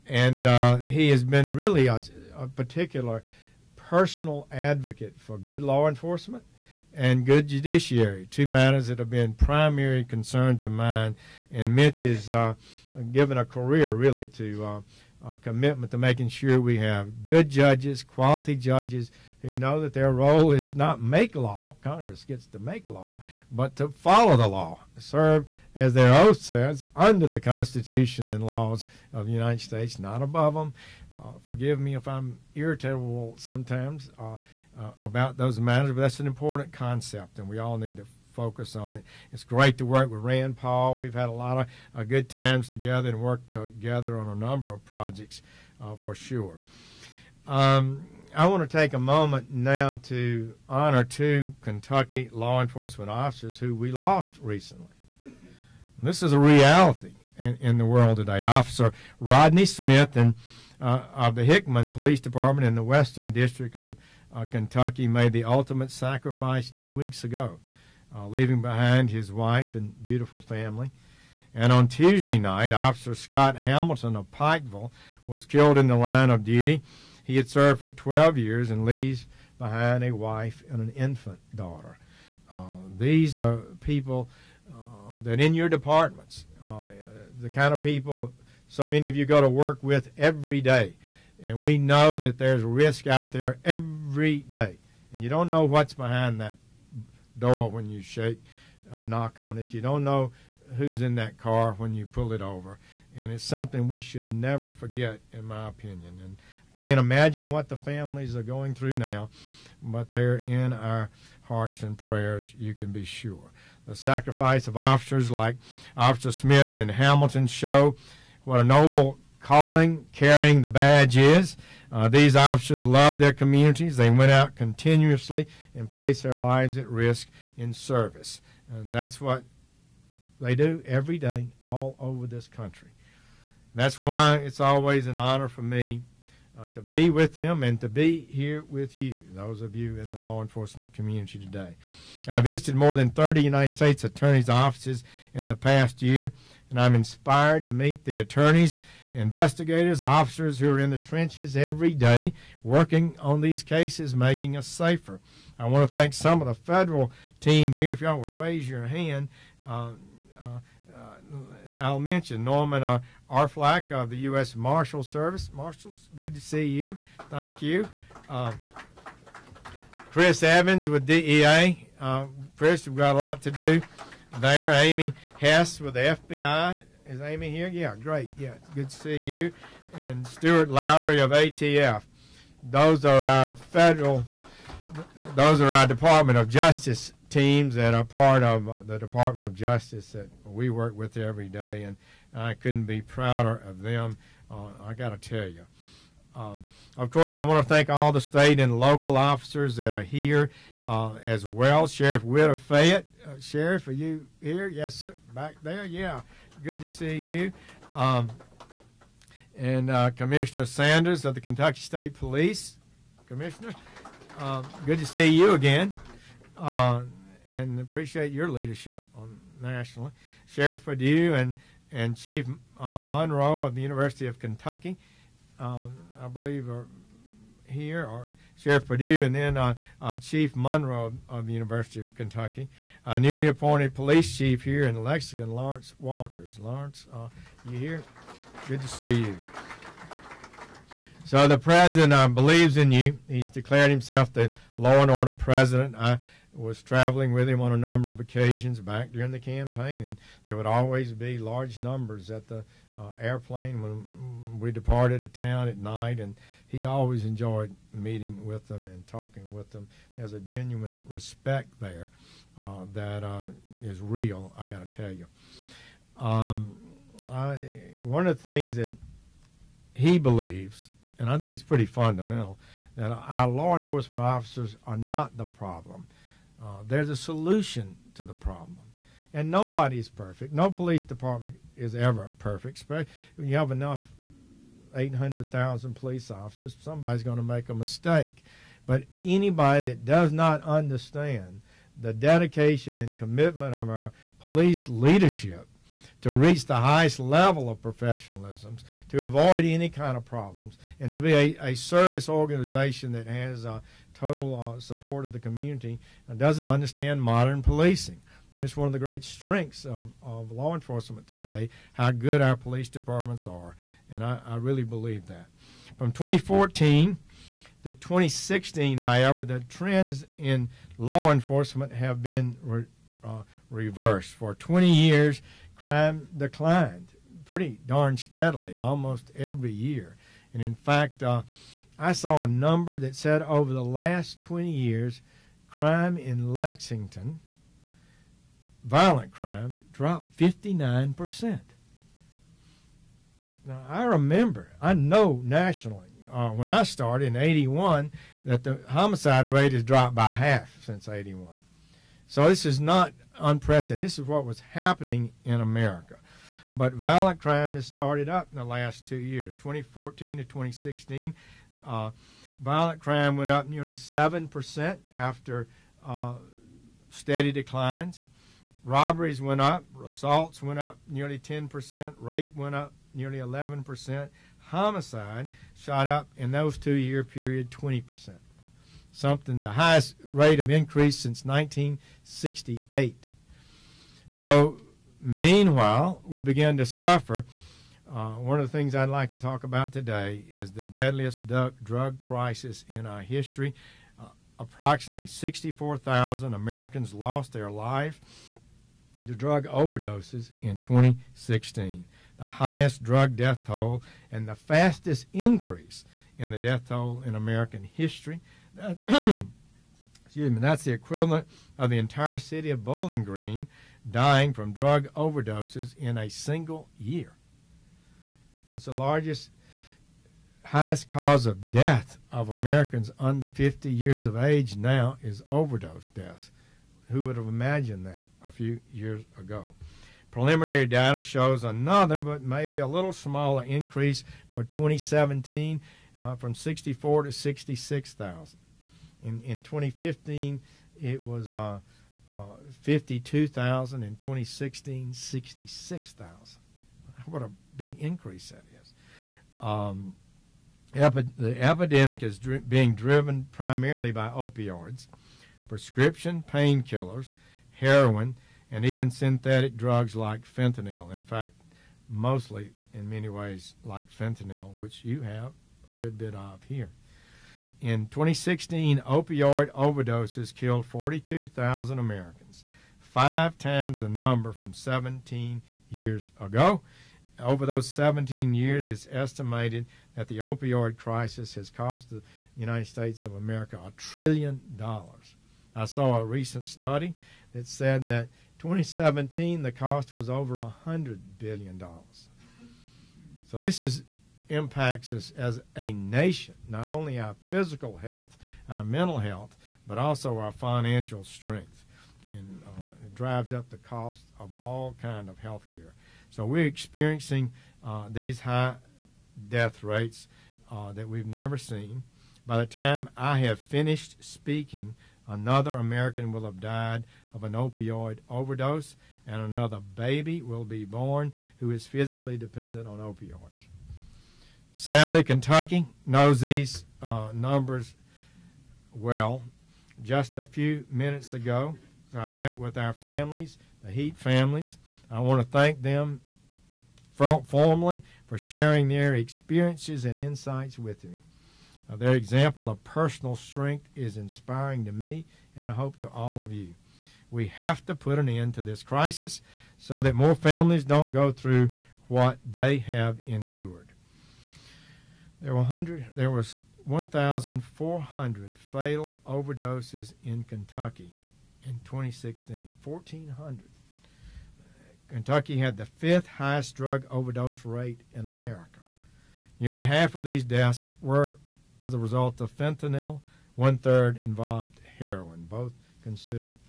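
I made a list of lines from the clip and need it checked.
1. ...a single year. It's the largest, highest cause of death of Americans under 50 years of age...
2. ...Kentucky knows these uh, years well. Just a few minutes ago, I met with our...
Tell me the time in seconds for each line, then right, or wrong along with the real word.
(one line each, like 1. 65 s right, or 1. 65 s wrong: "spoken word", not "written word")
1. 416 s right
2. 525 s wrong: "numbers", not "years".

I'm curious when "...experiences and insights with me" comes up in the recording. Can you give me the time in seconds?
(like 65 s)
539 s.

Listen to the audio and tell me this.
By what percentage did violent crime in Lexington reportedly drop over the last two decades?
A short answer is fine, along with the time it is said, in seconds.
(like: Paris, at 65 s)
59%, at 340 s.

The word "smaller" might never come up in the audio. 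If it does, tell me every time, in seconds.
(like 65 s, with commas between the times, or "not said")
433 s.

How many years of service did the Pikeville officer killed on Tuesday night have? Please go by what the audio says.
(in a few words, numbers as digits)
12.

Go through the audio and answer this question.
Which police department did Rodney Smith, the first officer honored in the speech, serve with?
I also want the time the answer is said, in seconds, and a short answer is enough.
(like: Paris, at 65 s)
Hickman Police Department, at 61 s.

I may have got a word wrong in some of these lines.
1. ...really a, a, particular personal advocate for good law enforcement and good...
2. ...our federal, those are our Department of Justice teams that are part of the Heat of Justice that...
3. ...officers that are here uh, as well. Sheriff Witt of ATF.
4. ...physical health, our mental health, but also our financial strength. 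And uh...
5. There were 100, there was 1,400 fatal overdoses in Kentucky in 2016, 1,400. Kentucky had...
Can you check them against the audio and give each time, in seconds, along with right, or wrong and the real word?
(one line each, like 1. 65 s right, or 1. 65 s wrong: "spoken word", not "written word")
1. 1 s right
2. 183 s wrong: "Department", not "Heat"
3. 199 s wrong: "Fayette", not "ATF"
4. 497 s right
5. 555 s right.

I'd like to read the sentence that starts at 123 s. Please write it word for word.
They went out continuously and placed their lives at risk in service.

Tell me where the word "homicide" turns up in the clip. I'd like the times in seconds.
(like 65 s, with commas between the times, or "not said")
348 s, 374 s.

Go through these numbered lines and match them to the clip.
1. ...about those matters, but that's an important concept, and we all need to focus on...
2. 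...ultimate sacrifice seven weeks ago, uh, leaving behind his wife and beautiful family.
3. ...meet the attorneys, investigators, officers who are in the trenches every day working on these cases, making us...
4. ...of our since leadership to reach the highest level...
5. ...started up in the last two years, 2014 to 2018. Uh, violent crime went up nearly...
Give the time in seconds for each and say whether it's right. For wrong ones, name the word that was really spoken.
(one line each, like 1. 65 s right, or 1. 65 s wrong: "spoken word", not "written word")
1. 35 s right
2. 65 s wrong: "two", not "seven"
3. 147 s right
4. 293 s wrong: "police", not "since"
5. 357 s wrong: "2016", not "2018".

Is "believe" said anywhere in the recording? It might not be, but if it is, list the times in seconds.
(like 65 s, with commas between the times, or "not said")
226 s, 242 s, 270 s, 314 s.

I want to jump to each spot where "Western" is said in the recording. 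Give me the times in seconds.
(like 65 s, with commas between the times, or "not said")
62 s.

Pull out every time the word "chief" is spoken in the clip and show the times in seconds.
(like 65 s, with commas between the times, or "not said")
222 s, 230 s, 234 s.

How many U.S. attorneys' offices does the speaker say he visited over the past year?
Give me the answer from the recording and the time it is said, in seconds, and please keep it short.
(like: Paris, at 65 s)
more than 30, at 142 s.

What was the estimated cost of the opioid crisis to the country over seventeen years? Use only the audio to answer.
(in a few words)
a trillion dollars.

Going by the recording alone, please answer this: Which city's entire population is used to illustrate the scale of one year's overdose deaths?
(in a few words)
Bowling Green.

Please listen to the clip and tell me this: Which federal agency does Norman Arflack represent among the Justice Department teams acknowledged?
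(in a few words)
U.S. Marshal Service.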